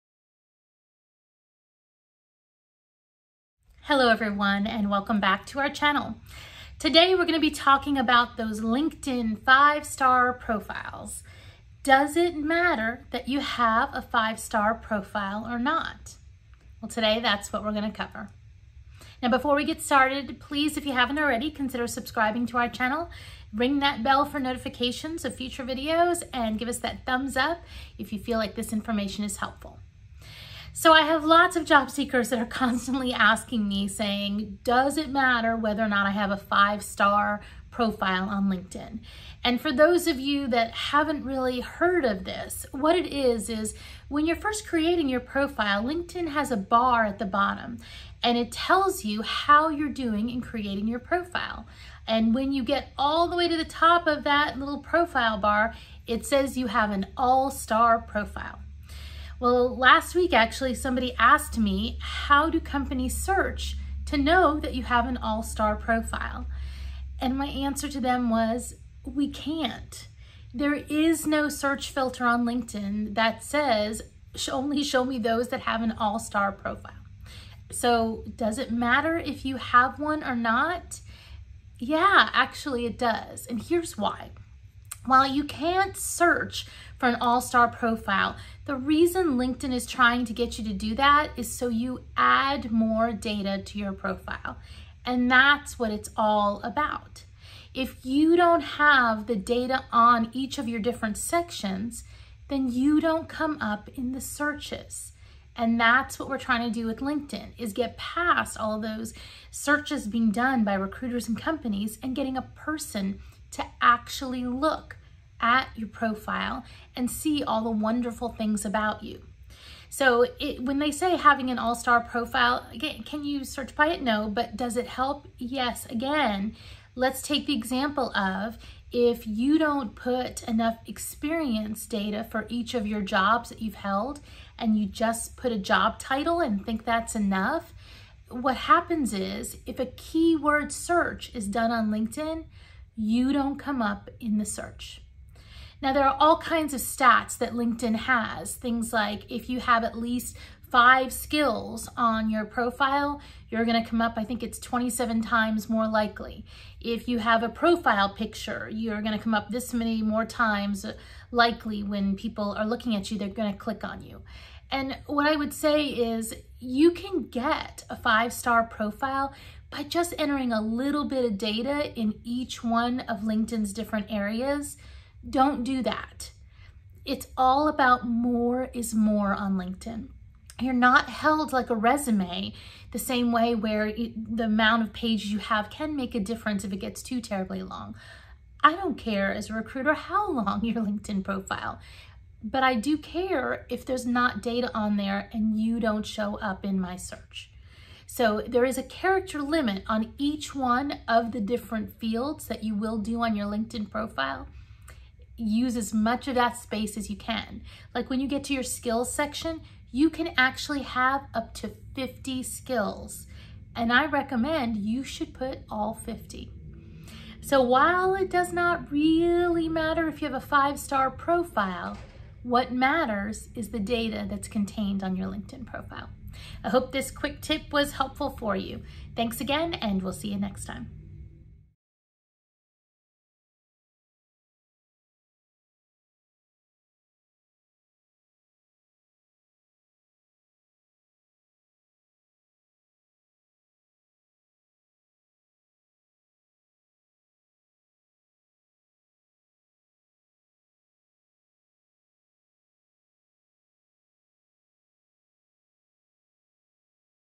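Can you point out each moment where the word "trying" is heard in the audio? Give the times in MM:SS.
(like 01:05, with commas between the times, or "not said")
01:29, 01:46.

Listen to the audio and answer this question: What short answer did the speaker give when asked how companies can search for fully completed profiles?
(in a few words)
We can't.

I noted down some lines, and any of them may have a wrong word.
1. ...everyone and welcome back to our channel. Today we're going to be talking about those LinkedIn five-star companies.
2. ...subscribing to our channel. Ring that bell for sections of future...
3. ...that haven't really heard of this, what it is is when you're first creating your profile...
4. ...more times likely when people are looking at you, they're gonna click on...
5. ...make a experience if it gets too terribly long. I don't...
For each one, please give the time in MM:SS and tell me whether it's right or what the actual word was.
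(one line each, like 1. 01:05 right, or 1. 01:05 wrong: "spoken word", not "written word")
1. 00:04 wrong: "profiles", not "companies"
2. 00:21 wrong: "notifications", not "sections"
3. 00:40 right
4. 02:40 right
5. 03:05 wrong: "difference", not "experience".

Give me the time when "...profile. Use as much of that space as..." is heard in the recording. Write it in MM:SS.
03:23.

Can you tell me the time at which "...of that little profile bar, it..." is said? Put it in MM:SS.
00:54.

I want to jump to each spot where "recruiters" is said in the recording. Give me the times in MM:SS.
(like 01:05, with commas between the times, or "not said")
01:50, 03:09.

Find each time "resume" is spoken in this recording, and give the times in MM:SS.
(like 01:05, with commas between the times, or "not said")
03:01.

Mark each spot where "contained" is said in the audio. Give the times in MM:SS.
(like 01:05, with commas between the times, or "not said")
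03:44.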